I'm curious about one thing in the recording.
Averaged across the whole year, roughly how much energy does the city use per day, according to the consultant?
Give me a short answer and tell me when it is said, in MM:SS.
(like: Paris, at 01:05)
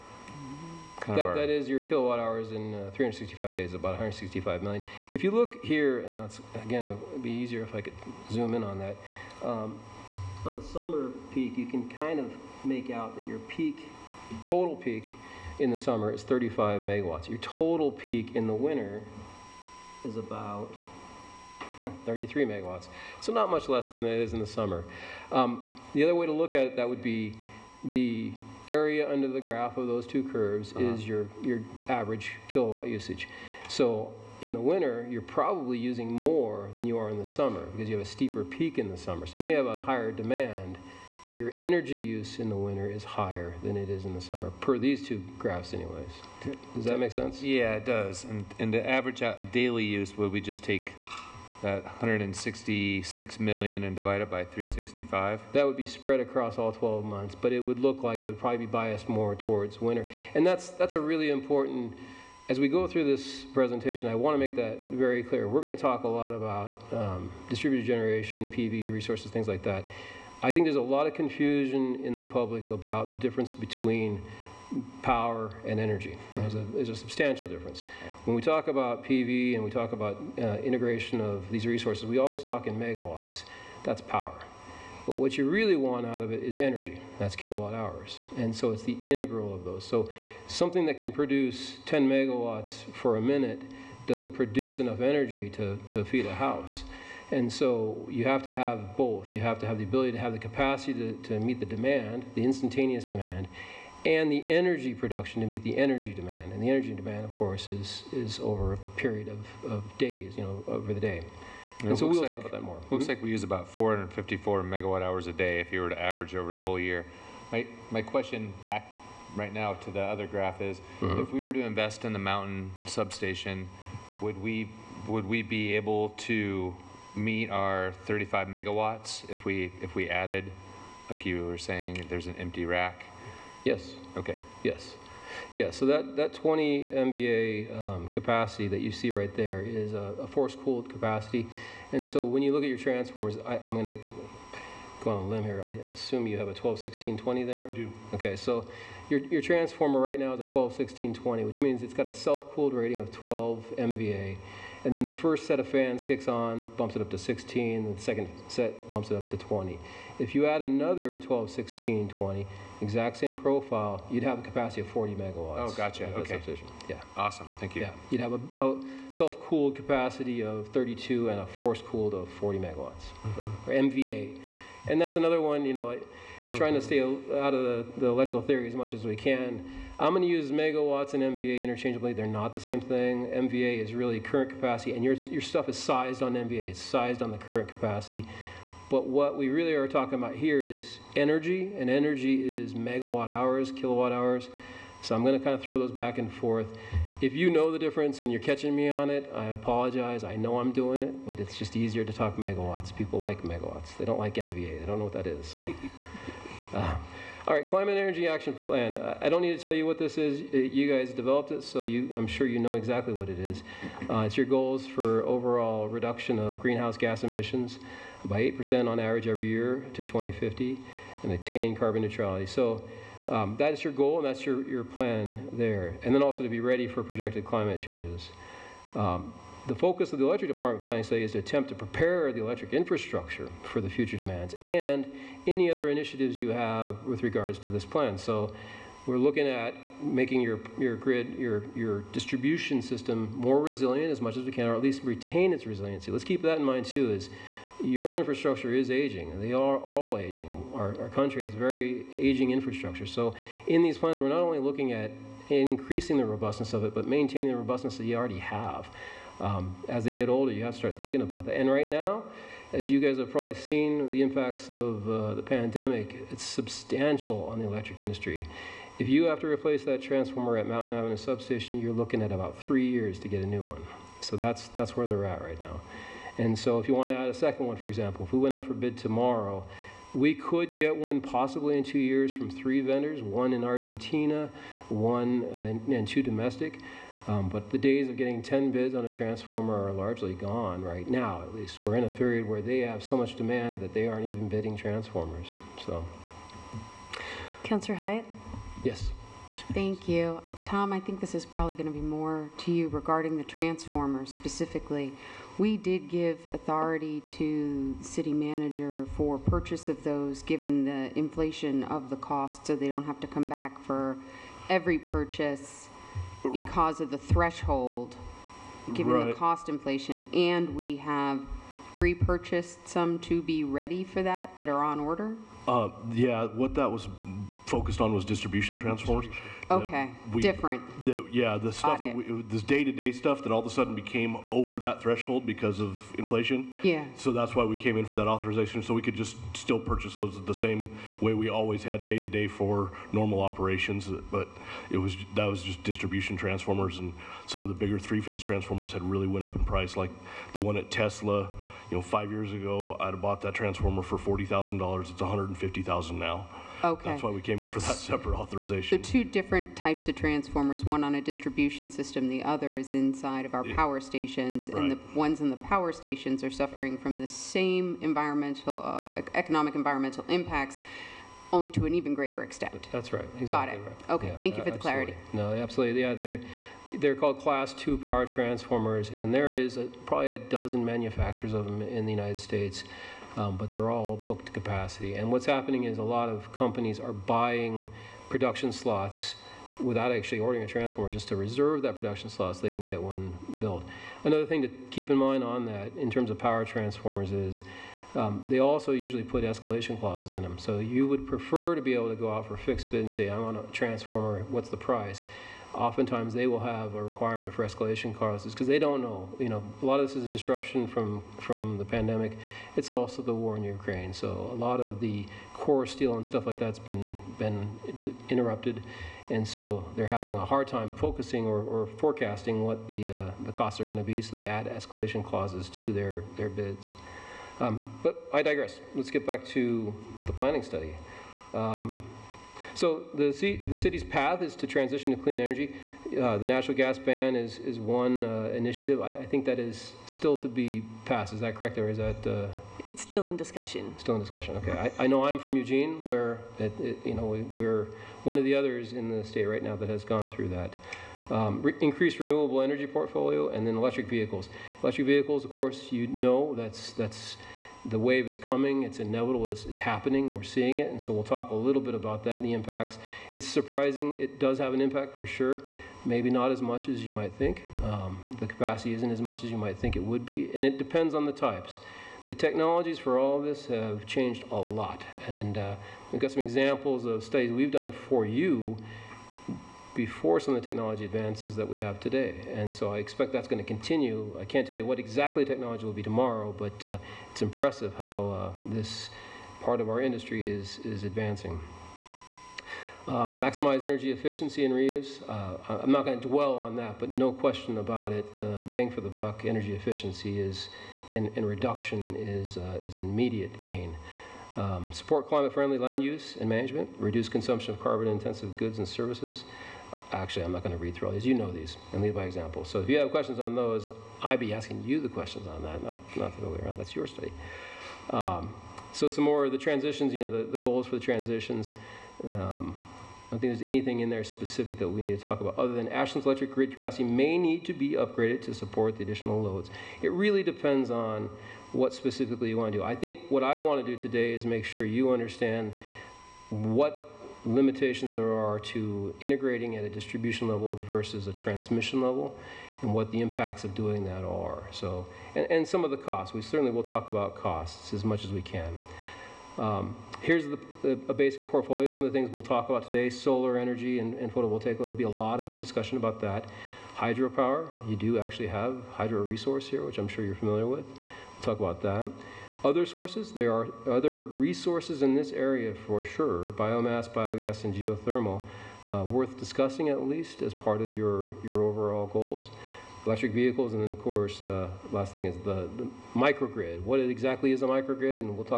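454 megawatt hours, at 01:53.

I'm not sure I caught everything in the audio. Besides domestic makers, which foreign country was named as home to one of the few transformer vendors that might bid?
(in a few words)
Argentina.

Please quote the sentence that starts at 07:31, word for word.
Um, re- increased renewable energy portfolio, and then electric vehicles.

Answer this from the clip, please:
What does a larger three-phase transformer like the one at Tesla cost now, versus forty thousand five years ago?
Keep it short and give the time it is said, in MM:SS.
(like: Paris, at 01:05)
$150,000, at 05:55.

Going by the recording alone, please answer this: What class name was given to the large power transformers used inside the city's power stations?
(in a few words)
Class II.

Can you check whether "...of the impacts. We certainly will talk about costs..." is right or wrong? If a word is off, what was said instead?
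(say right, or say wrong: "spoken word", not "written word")
wrong: "costs", not "impacts".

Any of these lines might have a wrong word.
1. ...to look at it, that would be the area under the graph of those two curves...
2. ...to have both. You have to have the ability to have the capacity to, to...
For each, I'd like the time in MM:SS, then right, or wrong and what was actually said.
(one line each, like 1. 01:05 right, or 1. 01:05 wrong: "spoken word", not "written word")
1. 00:26 right
2. 01:38 right.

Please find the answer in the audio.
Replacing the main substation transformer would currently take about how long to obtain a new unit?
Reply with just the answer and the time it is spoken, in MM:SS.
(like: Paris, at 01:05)
three years, at 04:32.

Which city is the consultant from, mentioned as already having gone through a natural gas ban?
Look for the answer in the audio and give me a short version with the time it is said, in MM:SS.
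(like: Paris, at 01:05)
Eugene, at 07:25.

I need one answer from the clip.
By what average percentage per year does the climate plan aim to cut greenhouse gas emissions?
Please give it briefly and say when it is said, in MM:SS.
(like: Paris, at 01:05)
8%, at 03:38.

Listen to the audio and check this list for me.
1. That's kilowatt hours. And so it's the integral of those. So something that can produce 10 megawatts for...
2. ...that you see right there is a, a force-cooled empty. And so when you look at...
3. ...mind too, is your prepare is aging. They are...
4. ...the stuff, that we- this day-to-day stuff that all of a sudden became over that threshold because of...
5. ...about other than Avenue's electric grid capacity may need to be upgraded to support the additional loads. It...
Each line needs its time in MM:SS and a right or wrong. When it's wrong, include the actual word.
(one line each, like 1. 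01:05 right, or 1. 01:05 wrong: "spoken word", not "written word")
1. 01:27 right
2. 02:18 wrong: "capacity", not "empty"
3. 04:06 wrong: "infrastructure", not "prepare"
4. 05:31 right
5. 08:45 wrong: "Ashland", not "Avenue".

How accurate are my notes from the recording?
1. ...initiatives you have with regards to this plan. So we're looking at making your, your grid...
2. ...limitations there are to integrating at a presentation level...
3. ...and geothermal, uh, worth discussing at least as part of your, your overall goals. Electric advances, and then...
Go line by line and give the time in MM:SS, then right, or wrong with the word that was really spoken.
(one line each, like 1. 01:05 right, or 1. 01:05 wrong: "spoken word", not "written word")
1. 03:55 right
2. 08:57 wrong: "distribution", not "presentation"
3. 09:27 wrong: "vehicles", not "advances".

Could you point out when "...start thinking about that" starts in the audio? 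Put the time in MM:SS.
04:20.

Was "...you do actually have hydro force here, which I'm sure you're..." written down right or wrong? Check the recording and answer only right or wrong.
wrong.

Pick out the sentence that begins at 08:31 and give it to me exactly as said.
You know these and lead by example.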